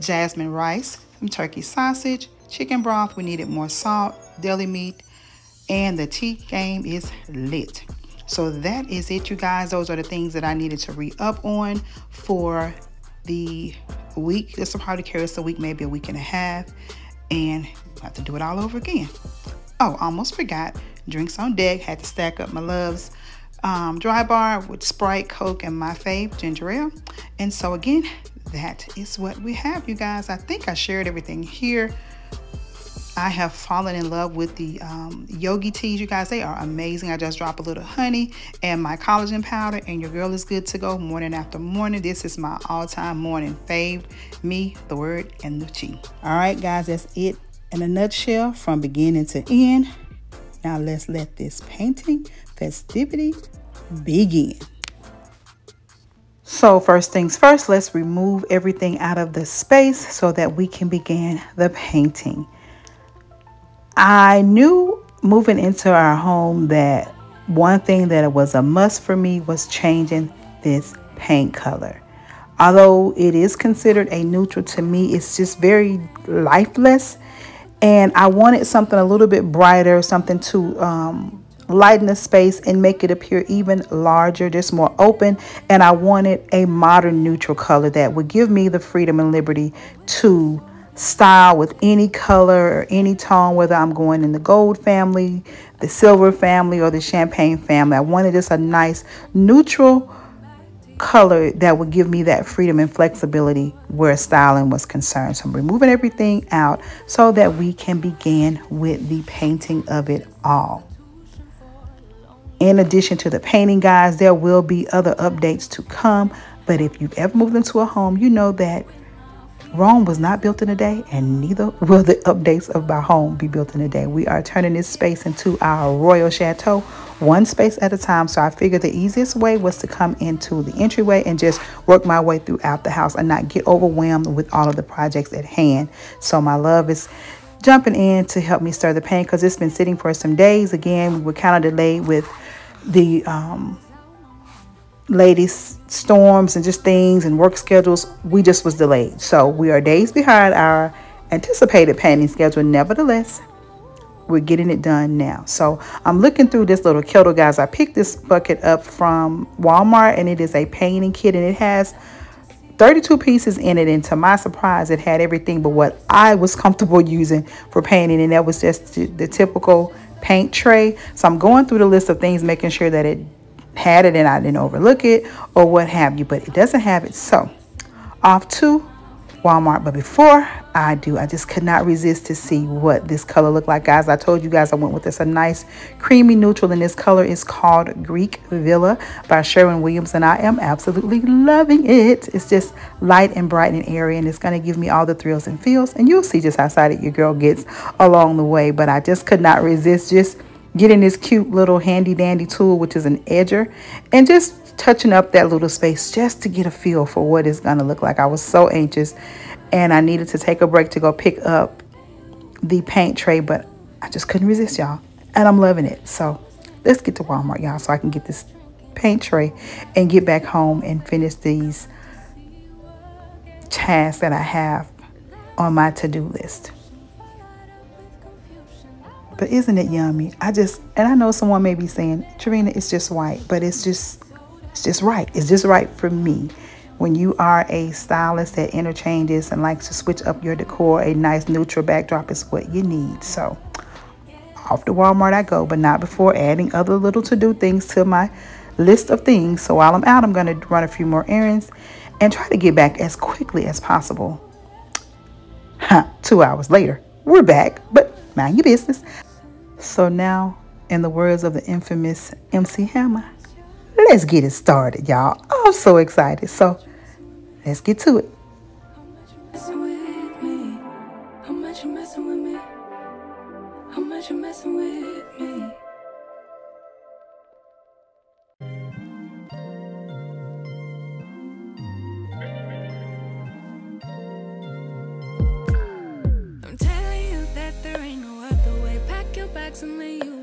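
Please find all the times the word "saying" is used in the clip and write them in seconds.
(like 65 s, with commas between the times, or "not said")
231 s.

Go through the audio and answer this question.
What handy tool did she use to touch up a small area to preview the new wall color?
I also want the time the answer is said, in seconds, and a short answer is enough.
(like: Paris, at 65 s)
An edger, at 203 s.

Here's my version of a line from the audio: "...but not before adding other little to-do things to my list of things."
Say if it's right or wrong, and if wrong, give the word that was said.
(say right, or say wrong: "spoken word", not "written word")
right.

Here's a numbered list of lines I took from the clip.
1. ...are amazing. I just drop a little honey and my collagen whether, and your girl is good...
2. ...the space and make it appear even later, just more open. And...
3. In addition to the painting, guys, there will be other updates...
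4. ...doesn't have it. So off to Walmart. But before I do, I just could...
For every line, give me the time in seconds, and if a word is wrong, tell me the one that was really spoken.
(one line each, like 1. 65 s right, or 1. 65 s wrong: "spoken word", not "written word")
1. 36 s wrong: "powder", not "whether"
2. 82 s wrong: "larger", not "later"
3. 112 s right
4. 176 s right.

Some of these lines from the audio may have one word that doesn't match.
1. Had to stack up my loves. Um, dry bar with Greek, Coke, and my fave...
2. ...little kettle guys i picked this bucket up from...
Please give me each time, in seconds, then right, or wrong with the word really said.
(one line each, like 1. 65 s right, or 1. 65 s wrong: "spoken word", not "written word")
1. 21 s wrong: "Sprite", not "Greek"
2. 156 s right.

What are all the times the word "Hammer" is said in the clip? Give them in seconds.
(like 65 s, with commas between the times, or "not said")
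262 s.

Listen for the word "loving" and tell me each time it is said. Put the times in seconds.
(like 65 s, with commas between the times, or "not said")
191 s, 215 s.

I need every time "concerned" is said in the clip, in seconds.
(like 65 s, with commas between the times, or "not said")
104 s.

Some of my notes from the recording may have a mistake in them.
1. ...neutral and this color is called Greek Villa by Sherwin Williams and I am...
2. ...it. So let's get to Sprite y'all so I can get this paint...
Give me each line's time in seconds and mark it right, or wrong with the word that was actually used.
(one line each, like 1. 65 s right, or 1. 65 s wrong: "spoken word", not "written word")
1. 186 s right
2. 215 s wrong: "Walmart", not "Sprite".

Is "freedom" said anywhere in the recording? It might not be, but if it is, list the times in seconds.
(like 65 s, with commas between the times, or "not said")
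88 s, 102 s.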